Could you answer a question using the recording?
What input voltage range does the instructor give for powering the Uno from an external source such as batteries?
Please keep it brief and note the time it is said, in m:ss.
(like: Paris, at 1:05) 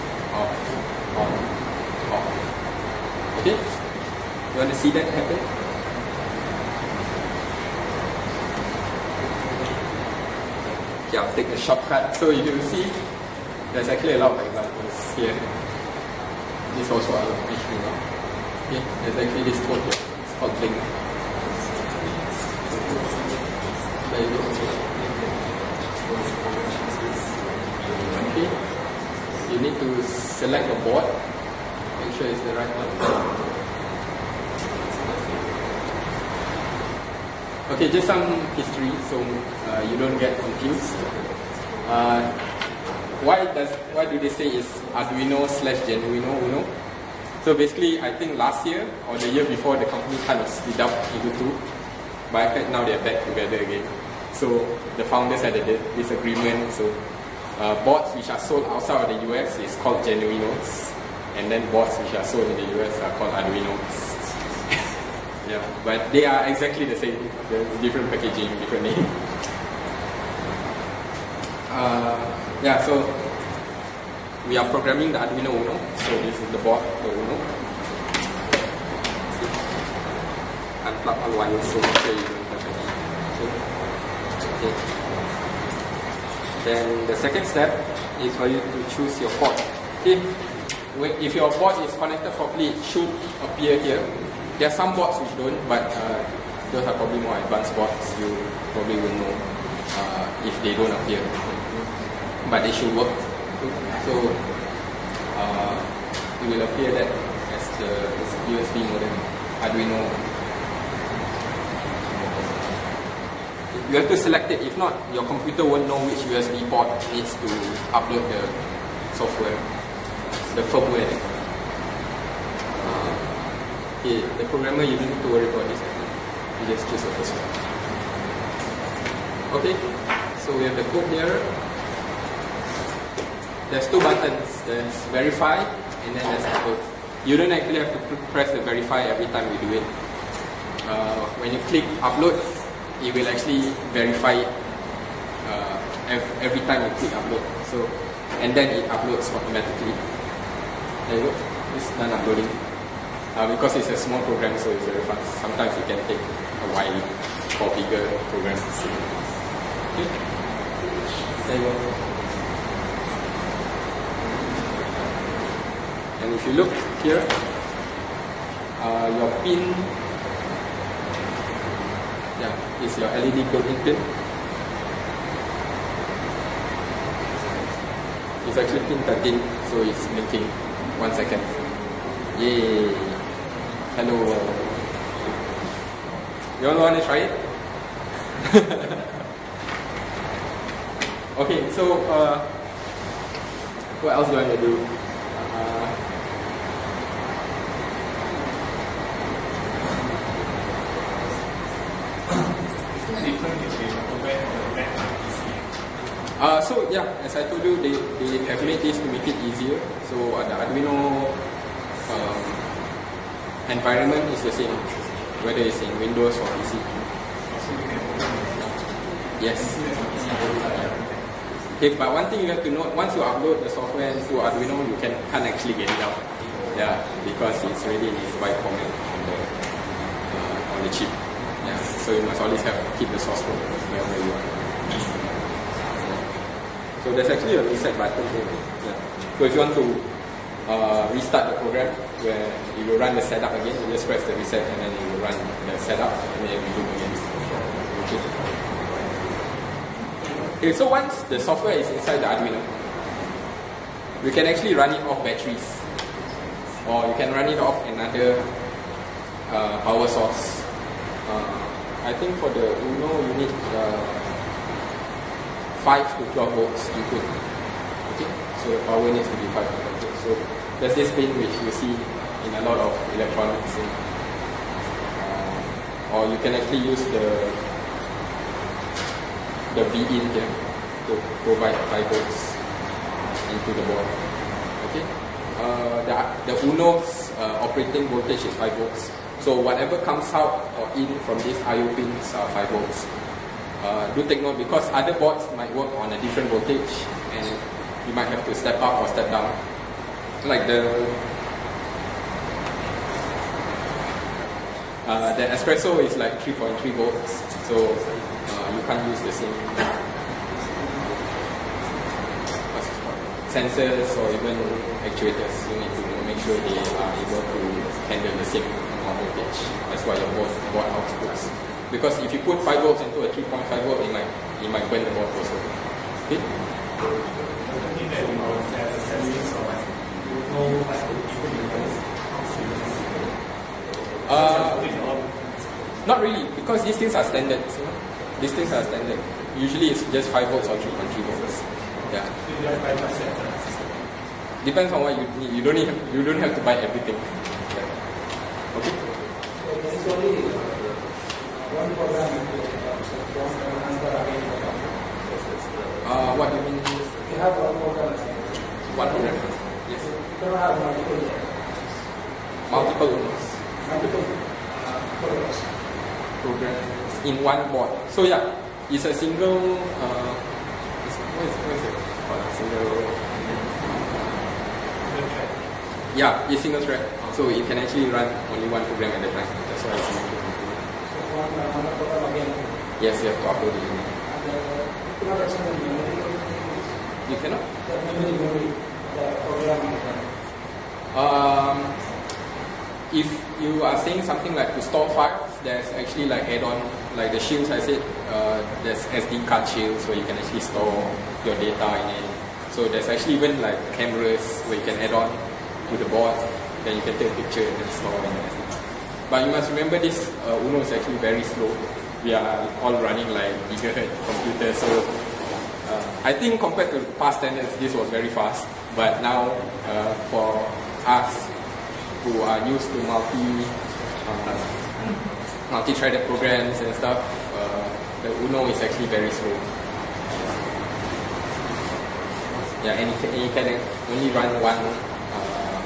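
5 to 12 volts, at 4:25.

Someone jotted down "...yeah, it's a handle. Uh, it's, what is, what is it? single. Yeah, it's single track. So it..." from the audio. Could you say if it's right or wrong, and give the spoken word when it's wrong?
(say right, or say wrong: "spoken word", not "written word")
wrong: "single", not "handle".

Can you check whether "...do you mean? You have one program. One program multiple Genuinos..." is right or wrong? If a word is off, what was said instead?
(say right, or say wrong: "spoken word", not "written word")
wrong: "Multiple", not "Genuinos".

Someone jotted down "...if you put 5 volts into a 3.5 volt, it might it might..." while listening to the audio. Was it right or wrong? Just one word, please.
right.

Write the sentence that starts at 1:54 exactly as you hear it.
If not, your computer won't know which USB port needs to upload the software, the firmware.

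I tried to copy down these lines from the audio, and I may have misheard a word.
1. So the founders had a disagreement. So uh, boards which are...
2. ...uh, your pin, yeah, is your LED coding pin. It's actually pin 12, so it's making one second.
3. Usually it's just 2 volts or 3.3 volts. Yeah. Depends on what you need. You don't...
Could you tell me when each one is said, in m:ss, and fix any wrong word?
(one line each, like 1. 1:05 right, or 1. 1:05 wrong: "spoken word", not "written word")
1. 0:54 right
2. 2:48 wrong: "13", not "12"
3. 5:39 wrong: "5", not "2".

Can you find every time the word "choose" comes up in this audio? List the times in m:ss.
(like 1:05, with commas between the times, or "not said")
1:28, 2:06.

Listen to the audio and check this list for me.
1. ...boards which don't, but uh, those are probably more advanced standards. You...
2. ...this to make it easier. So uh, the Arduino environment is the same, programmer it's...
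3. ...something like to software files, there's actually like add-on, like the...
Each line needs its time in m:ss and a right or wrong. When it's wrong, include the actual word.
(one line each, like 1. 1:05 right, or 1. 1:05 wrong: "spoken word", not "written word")
1. 1:34 wrong: "boards", not "standards"
2. 3:28 wrong: "whether", not "programmer"
3. 6:34 wrong: "store", not "software".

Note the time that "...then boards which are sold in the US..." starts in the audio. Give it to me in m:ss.
1:01.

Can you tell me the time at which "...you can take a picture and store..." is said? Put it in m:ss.
6:46.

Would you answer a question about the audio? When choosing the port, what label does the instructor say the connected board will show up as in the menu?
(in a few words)
USB modem Arduino.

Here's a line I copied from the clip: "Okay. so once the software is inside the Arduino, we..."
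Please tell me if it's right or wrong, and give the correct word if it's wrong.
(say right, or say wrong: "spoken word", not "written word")
right.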